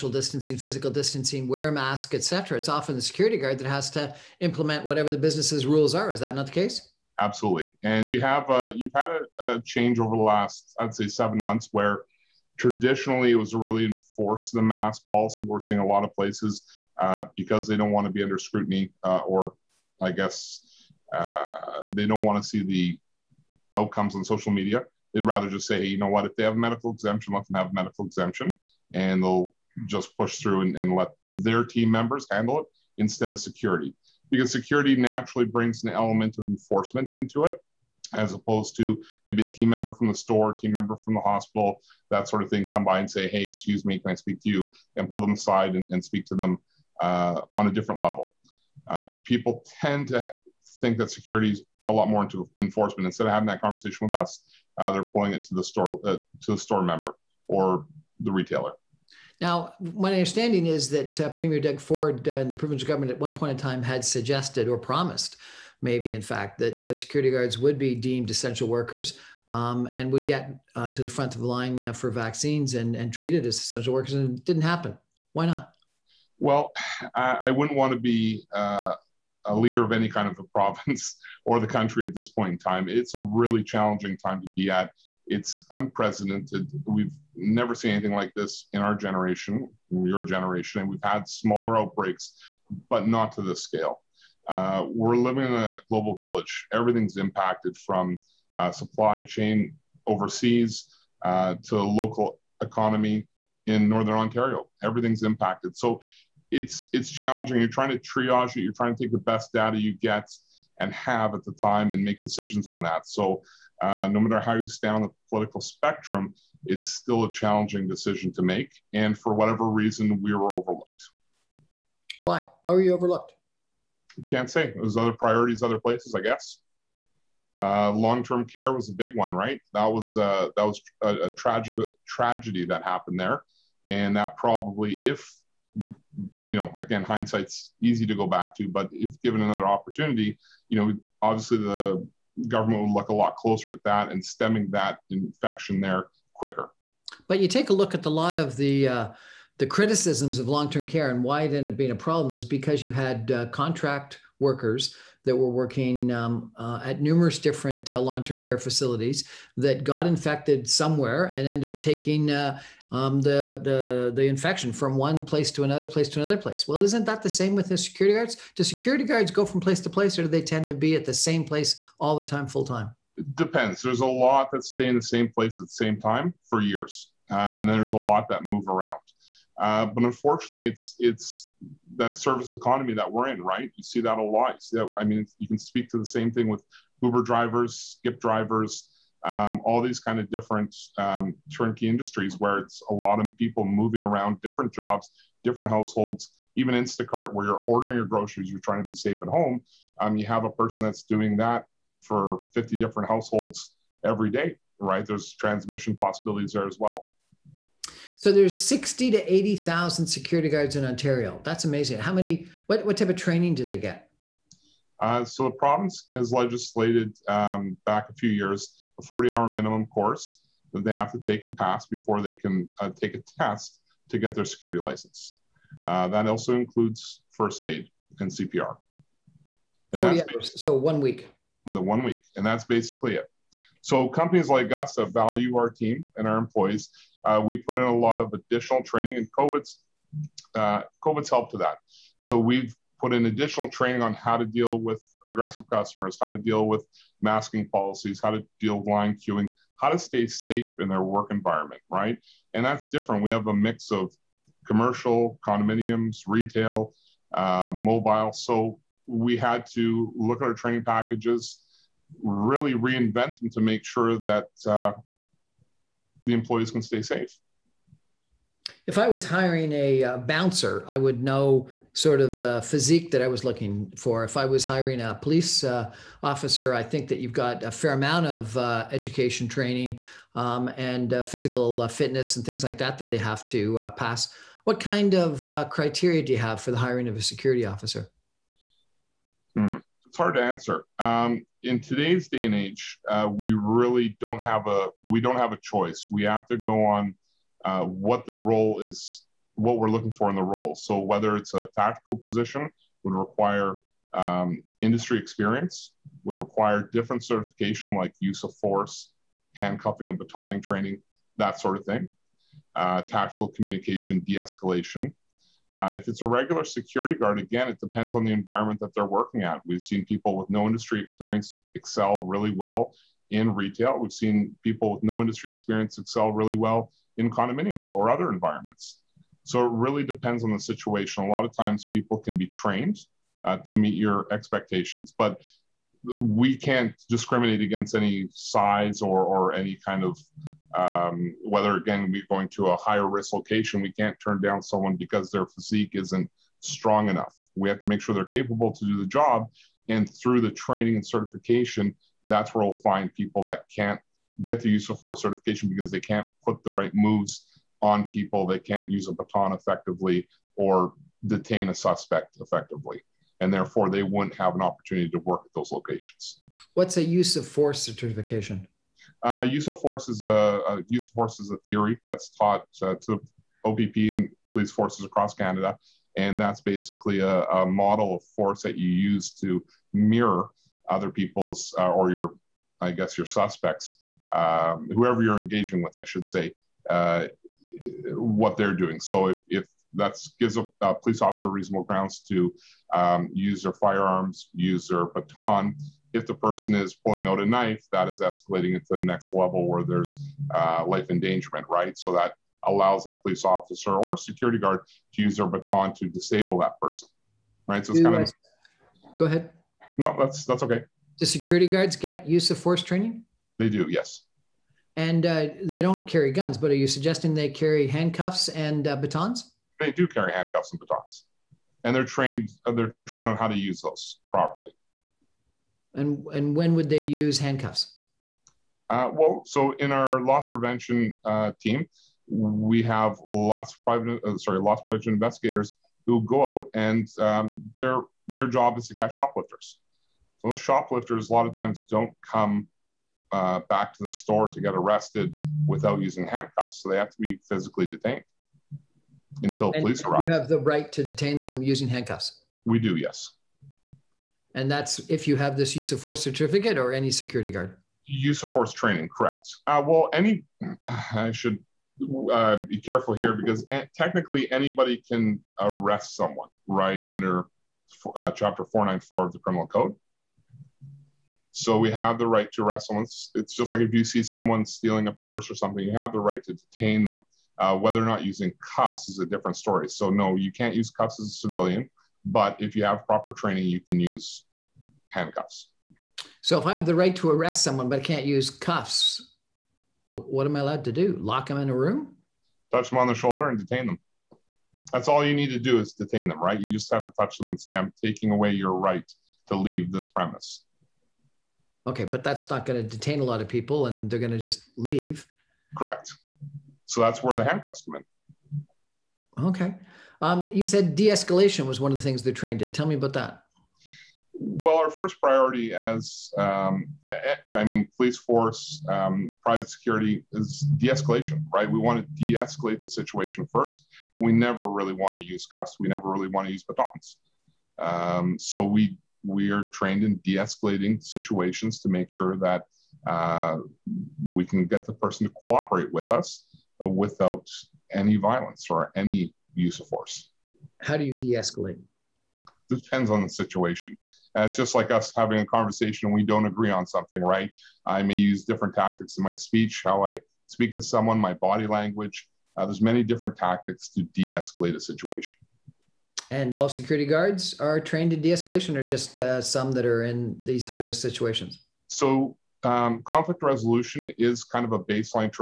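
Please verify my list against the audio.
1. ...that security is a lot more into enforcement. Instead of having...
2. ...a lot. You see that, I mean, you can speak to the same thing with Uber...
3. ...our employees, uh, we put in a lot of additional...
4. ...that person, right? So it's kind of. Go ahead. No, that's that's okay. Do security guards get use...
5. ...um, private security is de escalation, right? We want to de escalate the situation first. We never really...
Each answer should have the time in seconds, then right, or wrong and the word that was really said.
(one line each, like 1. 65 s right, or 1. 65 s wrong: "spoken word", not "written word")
1. 50 s right
2. 184 s right
3. 236 s right
4. 406 s right
5. 518 s right.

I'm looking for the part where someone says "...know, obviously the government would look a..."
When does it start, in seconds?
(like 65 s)
140 s.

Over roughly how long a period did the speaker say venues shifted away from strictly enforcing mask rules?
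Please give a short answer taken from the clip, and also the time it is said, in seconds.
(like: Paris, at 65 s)
7 months, at 11 s.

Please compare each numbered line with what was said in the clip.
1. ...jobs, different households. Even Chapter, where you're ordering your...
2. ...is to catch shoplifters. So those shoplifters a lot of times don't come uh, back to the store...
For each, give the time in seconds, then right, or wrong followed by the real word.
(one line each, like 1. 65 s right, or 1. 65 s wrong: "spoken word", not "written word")
1. 194 s wrong: "Instacart", not "Chapter"
2. 438 s right.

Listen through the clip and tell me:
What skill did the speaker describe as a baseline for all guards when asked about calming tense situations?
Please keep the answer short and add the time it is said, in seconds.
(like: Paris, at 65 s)
Conflict resolution, at 563 s.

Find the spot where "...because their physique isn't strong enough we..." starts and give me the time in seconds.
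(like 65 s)
344 s.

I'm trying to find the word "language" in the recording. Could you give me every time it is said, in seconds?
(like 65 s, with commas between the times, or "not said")
551 s.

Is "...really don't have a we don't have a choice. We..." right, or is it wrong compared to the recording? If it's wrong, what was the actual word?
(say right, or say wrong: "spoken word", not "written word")
right.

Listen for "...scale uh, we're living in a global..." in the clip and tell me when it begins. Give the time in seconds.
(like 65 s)
93 s.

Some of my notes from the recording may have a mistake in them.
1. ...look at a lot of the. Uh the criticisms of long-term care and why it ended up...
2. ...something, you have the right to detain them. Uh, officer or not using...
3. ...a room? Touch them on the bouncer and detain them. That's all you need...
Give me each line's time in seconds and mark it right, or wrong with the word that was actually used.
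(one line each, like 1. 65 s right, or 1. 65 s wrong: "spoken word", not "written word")
1. 147 s right
2. 475 s wrong: "whether", not "officer"
3. 491 s wrong: "shoulder", not "bouncer".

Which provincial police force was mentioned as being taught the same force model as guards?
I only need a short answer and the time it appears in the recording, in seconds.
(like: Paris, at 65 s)
OPP, at 373 s.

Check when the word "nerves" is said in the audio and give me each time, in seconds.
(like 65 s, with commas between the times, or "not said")
not said.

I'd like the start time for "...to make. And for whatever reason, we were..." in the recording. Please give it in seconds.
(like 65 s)
118 s.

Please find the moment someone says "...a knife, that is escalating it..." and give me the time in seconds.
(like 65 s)
397 s.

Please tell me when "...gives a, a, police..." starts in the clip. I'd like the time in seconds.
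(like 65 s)
390 s.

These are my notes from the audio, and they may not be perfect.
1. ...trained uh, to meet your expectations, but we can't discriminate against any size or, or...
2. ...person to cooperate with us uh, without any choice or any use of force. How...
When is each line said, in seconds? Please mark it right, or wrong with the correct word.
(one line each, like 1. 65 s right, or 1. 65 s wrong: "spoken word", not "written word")
1. 332 s right
2. 534 s wrong: "violence", not "choice".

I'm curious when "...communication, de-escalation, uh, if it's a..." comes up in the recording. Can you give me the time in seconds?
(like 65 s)
313 s.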